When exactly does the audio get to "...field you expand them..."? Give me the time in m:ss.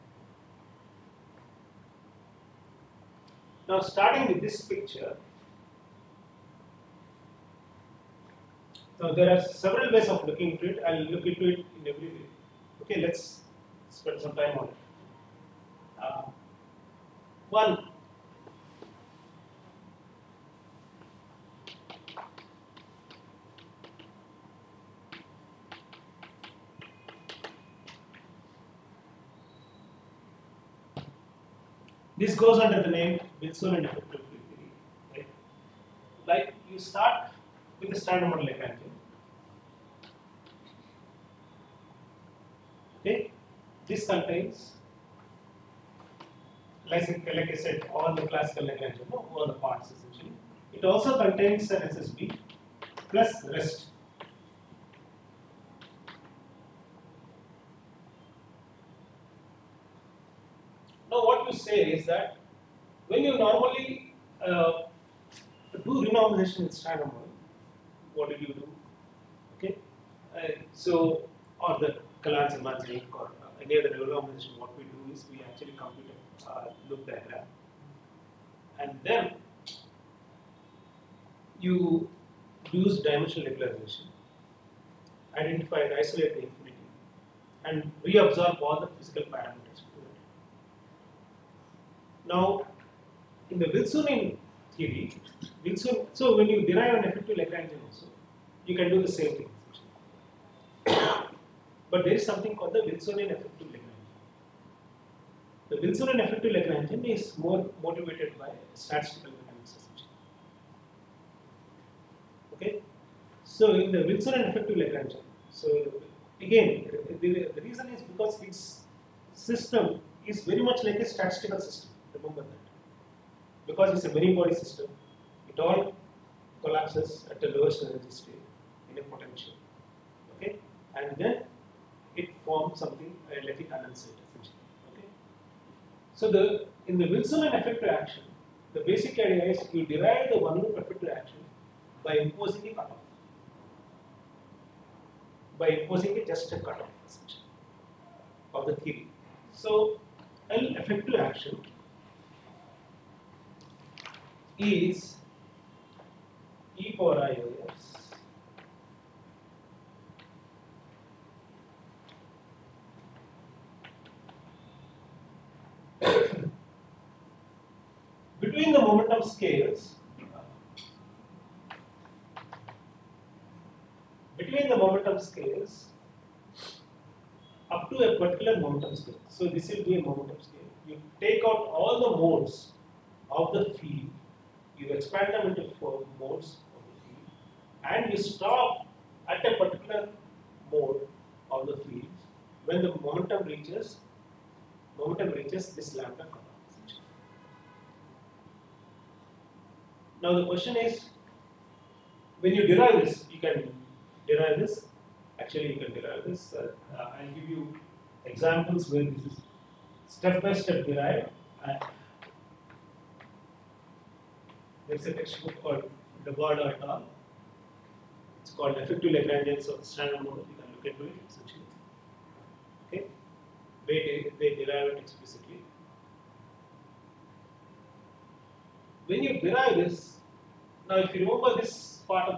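3:03.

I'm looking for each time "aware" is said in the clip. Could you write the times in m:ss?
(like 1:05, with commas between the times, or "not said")
not said.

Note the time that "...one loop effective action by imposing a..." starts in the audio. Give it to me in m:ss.
2:20.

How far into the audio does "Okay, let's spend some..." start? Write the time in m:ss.
0:12.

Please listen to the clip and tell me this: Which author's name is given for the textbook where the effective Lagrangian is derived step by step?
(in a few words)
Dobado.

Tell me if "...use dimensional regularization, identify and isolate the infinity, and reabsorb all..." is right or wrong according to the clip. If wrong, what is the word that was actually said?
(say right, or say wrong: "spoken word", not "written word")
right.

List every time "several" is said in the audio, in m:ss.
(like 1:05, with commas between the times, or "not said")
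0:09.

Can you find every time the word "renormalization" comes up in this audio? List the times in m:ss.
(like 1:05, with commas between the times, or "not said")
1:06, 1:13.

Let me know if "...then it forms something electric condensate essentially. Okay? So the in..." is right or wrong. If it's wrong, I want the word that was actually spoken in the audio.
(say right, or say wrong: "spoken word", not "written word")
right.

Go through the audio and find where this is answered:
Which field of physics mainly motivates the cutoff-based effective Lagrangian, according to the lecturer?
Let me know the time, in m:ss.
1:48.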